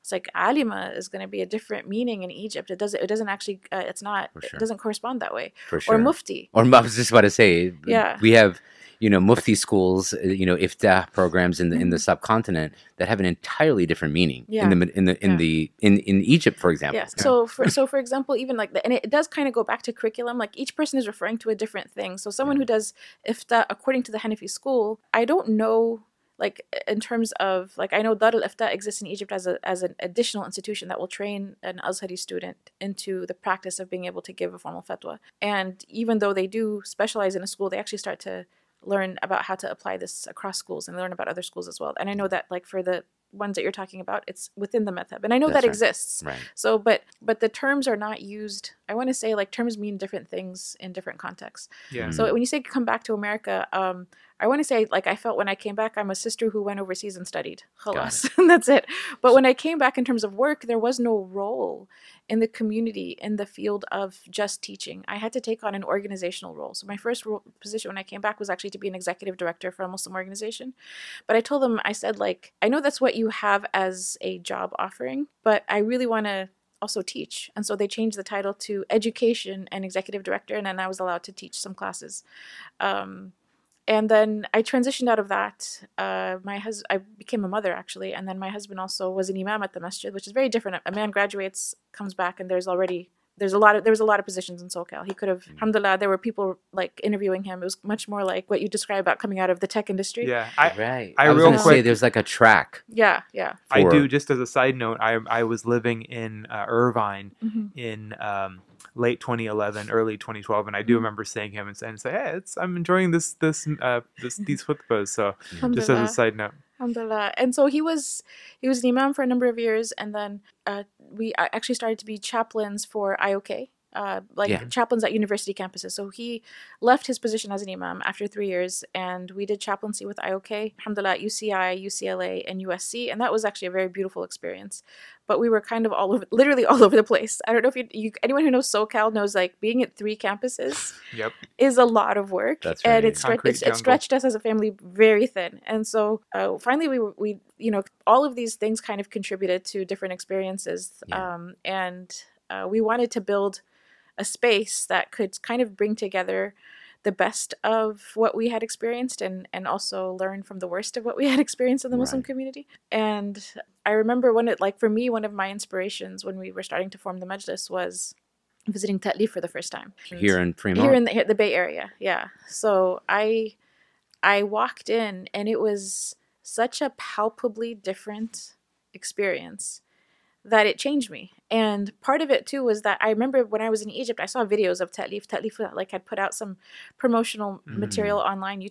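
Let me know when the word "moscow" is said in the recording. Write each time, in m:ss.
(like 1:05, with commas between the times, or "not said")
not said.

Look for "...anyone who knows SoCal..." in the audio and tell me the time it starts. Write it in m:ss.
2:18.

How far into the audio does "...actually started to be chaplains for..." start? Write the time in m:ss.
2:01.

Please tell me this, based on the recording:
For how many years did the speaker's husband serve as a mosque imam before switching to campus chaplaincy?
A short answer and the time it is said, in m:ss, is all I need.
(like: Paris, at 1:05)
3, at 2:08.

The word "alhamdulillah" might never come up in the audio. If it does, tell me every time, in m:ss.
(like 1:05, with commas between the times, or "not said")
1:35, 1:56, 2:10.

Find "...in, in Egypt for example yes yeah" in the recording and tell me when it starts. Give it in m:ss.
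0:15.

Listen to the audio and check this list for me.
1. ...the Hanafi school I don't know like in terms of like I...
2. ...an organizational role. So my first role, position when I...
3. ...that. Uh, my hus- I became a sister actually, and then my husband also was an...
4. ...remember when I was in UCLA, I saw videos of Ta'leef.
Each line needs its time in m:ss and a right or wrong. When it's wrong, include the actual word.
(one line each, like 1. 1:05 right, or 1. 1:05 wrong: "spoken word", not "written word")
1. 0:24 right
2. 1:05 right
3. 1:25 wrong: "mother", not "sister"
4. 3:03 wrong: "Egypt", not "UCLA".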